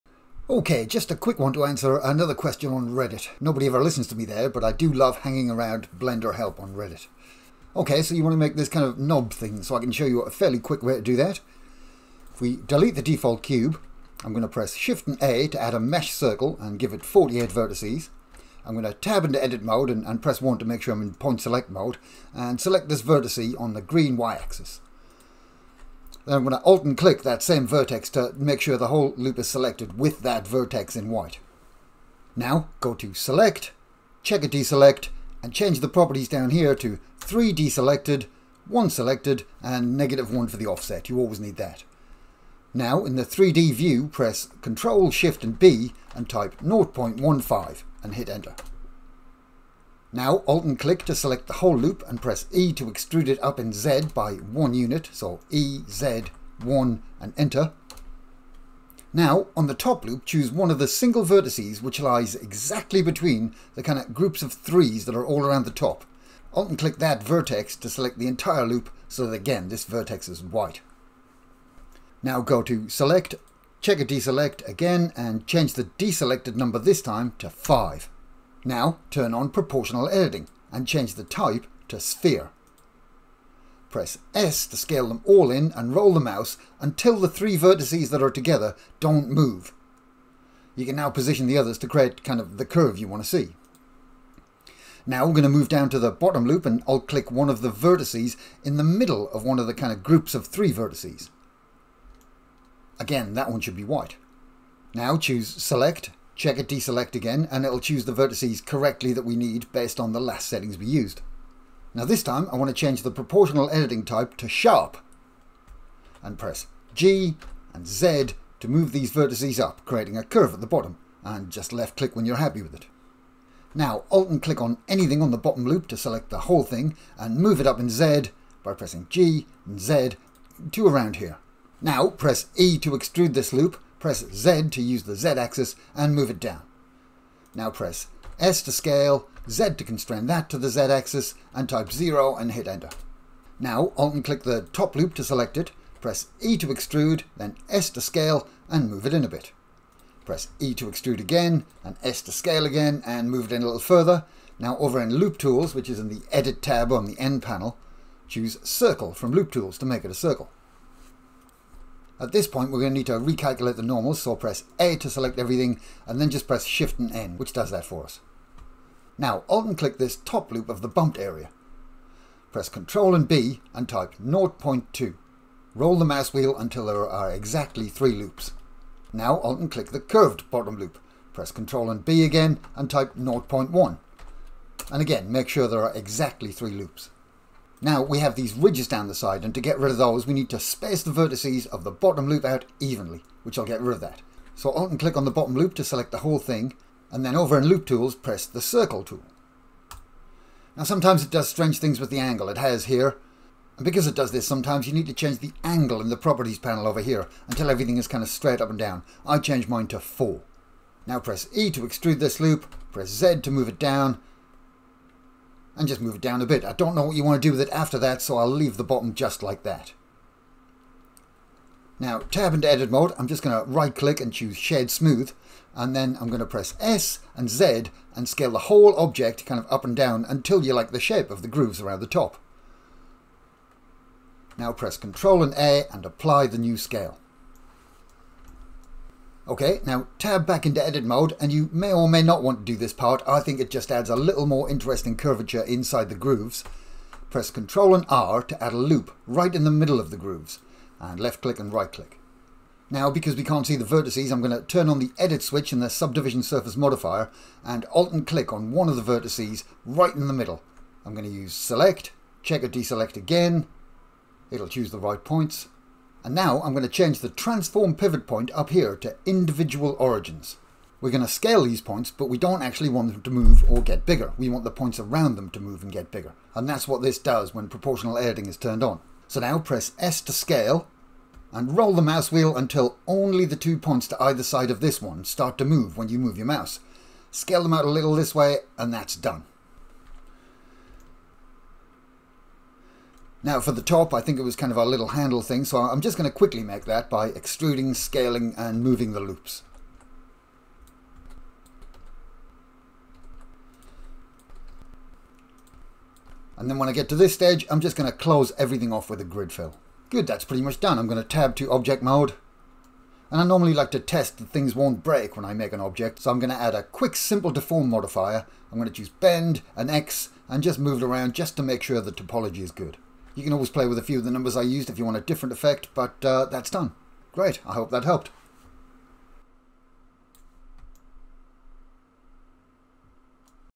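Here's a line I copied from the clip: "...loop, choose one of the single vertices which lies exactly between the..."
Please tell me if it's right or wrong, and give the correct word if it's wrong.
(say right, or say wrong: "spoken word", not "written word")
right.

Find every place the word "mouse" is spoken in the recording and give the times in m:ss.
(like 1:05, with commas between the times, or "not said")
1:26, 2:56, 4:42, 4:46.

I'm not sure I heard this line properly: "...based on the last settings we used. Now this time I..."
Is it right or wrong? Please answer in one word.
right.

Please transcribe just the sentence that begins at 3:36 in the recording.
I don't know what you want to do with it after that, so I'll leave the bottom just like that.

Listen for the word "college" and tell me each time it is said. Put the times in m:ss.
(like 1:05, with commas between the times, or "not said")
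not said.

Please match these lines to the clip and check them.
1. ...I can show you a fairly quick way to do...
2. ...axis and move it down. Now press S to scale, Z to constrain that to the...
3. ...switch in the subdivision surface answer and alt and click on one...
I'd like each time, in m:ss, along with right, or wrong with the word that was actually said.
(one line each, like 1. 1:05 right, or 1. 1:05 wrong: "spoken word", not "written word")
1. 0:09 right
2. 2:15 right
3. 4:15 wrong: "modifier", not "answer".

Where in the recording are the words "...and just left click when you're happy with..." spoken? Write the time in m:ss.
2:01.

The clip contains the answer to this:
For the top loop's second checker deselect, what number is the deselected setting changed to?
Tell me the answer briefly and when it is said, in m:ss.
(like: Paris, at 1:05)
5, at 1:17.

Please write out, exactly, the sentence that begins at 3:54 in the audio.
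Now press Control and A and apply the new scale.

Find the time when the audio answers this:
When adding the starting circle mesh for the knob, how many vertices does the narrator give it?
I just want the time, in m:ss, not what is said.
0:17.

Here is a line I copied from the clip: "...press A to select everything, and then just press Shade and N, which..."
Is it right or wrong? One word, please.
wrong.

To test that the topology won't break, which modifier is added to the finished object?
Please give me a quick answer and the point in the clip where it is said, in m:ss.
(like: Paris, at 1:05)
Simple deform, at 5:17.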